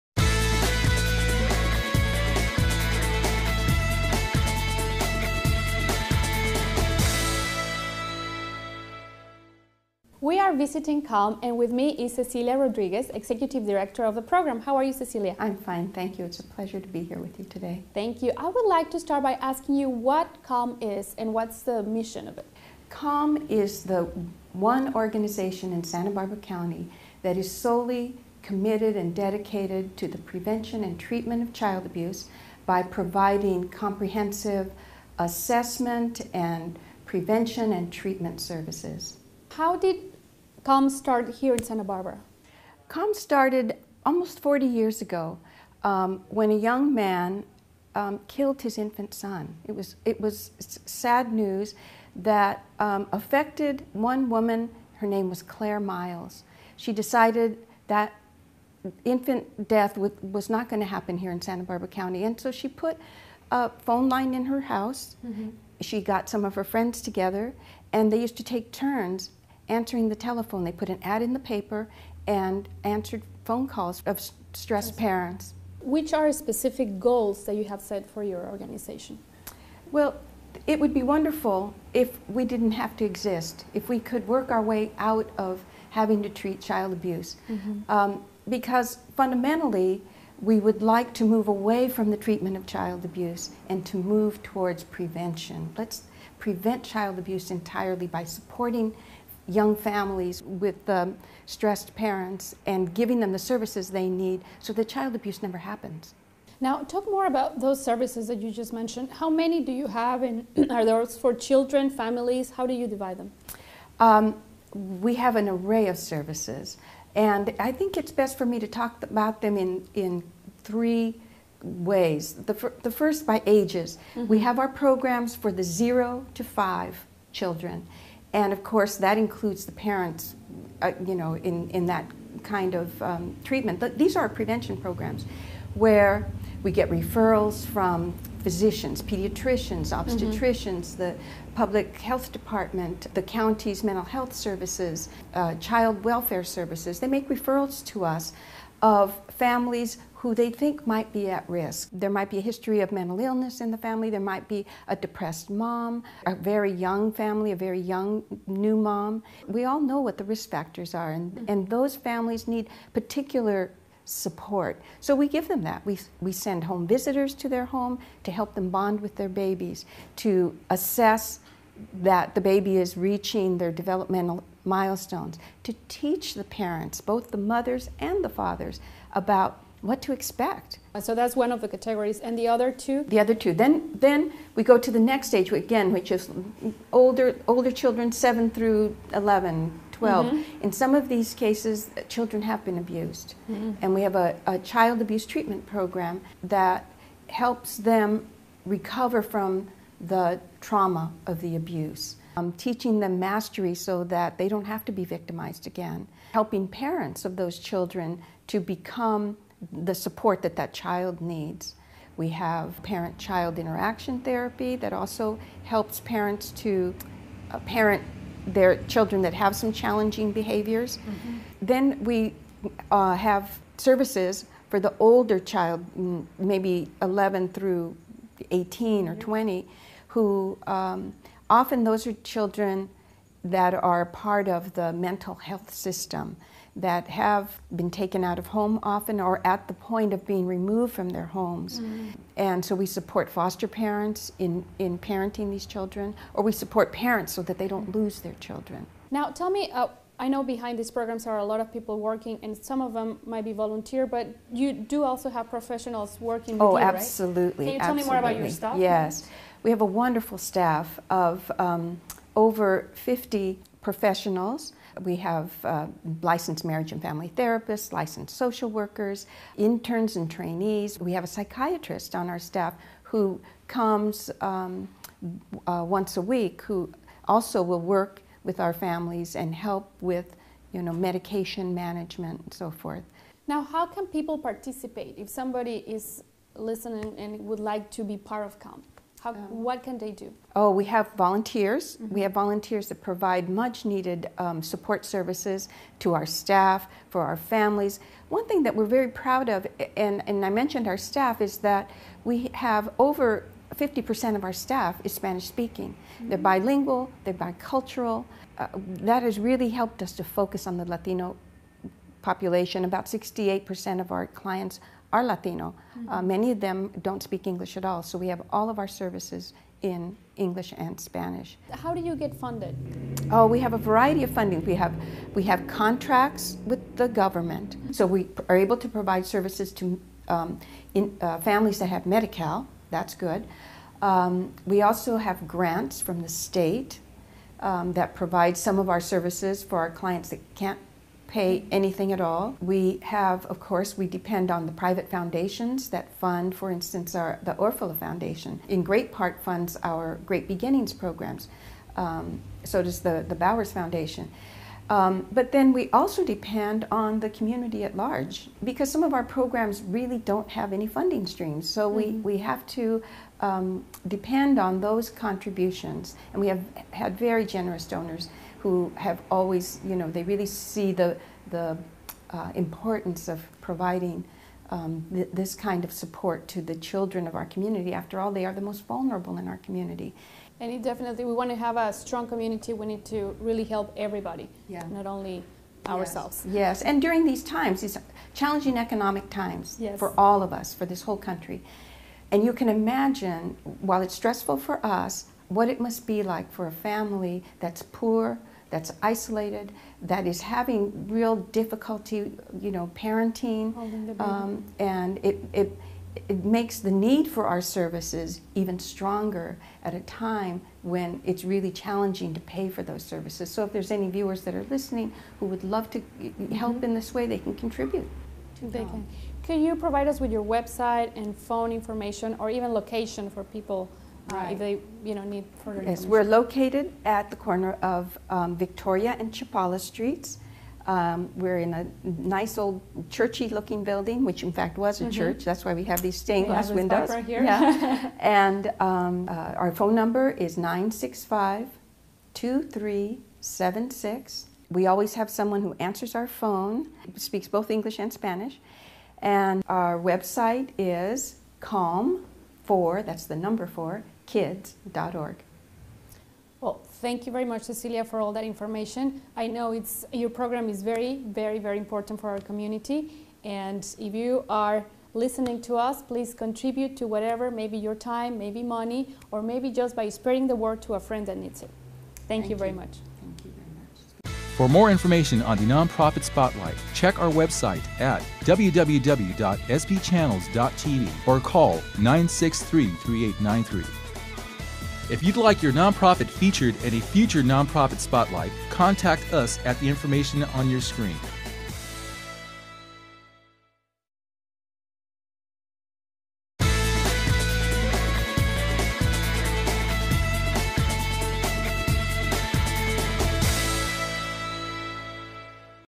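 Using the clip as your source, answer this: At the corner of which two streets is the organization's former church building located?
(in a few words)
Victoria and Chapala.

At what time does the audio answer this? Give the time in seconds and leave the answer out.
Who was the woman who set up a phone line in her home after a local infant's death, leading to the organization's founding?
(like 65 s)
55 s.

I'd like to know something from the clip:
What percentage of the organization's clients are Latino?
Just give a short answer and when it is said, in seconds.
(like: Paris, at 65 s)
68%, at 313 s.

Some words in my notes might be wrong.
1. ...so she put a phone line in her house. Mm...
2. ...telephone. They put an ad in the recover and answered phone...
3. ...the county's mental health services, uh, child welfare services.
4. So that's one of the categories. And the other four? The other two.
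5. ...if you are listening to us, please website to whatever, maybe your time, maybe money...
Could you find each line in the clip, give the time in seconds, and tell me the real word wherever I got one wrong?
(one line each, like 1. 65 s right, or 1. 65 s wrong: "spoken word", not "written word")
1. 62 s right
2. 70 s wrong: "paper", not "recover"
3. 143 s right
4. 180 s wrong: "two", not "four"
5. 463 s wrong: "contribute", not "website".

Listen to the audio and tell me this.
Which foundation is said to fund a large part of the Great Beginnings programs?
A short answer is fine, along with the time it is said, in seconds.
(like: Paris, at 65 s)
Orfalea Foundation, at 347 s.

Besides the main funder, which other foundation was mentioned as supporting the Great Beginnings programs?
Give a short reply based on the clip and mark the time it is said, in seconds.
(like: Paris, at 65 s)
Bowers Foundation, at 353 s.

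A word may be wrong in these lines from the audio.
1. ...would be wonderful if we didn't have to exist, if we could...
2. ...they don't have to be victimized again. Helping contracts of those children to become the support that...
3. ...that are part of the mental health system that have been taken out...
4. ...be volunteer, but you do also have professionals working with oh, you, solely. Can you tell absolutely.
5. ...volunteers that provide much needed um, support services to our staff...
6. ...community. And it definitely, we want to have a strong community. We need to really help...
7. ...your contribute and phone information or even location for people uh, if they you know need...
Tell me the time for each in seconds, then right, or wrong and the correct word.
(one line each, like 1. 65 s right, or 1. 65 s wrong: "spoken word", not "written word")
1. 80 s right
2. 204 s wrong: "parents", not "contracts"
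3. 233 s right
4. 253 s wrong: "absolutely", not "solely"
5. 292 s right
6. 379 s right
7. 420 s wrong: "website", not "contribute".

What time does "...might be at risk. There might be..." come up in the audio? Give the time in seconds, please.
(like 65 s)
150 s.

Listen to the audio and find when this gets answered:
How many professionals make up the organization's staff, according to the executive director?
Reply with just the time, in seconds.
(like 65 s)
262 s.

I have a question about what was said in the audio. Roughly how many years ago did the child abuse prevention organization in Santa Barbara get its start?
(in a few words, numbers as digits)
40.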